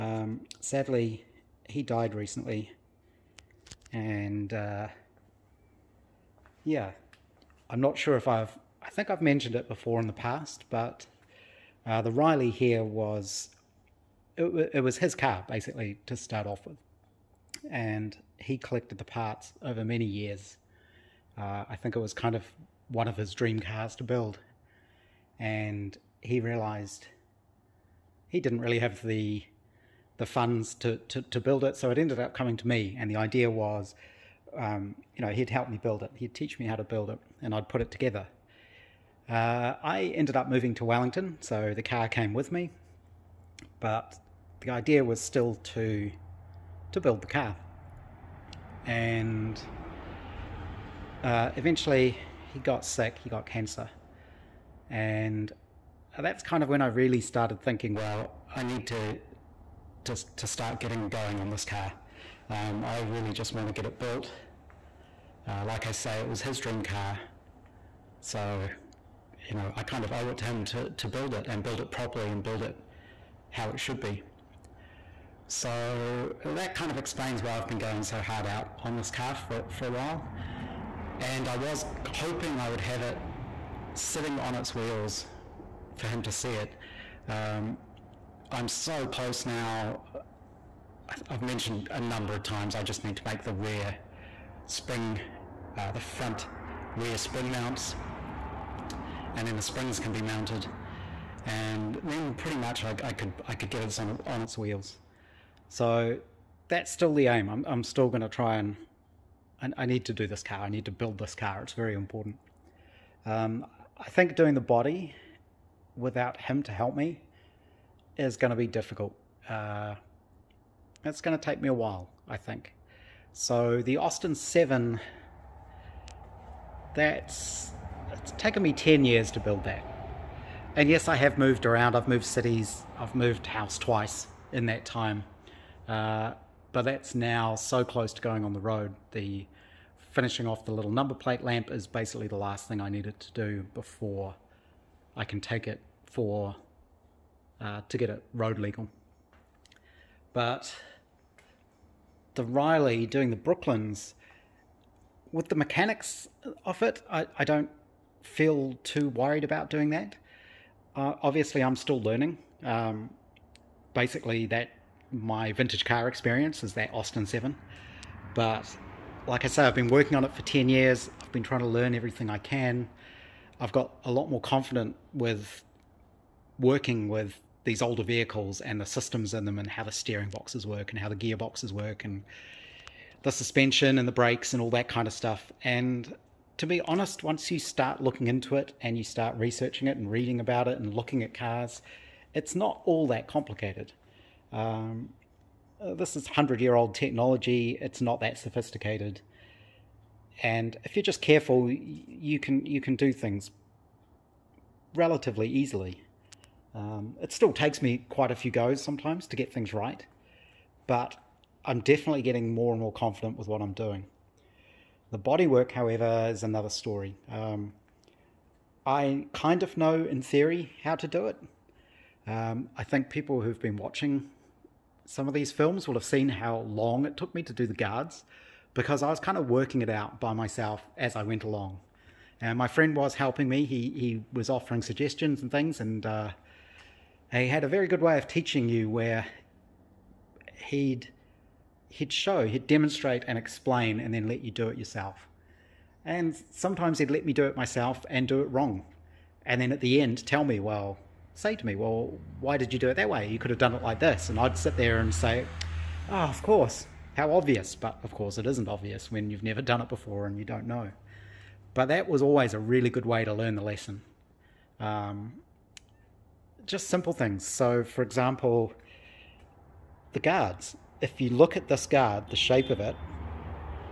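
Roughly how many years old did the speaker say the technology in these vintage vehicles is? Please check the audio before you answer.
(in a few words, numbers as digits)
100.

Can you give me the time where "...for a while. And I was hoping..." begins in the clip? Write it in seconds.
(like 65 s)
79 s.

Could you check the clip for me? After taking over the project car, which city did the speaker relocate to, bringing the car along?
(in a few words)
Wellington.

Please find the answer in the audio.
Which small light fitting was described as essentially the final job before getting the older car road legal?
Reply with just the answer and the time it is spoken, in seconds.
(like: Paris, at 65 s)
number plate lamp, at 140 s.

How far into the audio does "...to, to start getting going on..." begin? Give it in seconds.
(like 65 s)
60 s.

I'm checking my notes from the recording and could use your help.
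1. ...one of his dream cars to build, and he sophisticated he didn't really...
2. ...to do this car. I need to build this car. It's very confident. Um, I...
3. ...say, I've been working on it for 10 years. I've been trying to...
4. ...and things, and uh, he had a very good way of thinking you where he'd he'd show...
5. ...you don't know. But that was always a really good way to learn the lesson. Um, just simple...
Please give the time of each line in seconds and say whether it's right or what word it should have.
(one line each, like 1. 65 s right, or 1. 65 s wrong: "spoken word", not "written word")
1. 22 s wrong: "realized", not "sophisticated"
2. 110 s wrong: "important", not "confident"
3. 169 s right
4. 235 s wrong: "teaching", not "thinking"
5. 260 s right.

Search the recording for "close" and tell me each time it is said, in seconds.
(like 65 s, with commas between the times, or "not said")
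89 s, 137 s.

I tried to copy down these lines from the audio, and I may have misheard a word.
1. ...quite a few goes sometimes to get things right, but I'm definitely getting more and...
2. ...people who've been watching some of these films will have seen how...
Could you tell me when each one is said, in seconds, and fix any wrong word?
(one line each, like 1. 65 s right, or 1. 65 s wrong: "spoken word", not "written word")
1. 208 s right
2. 223 s right.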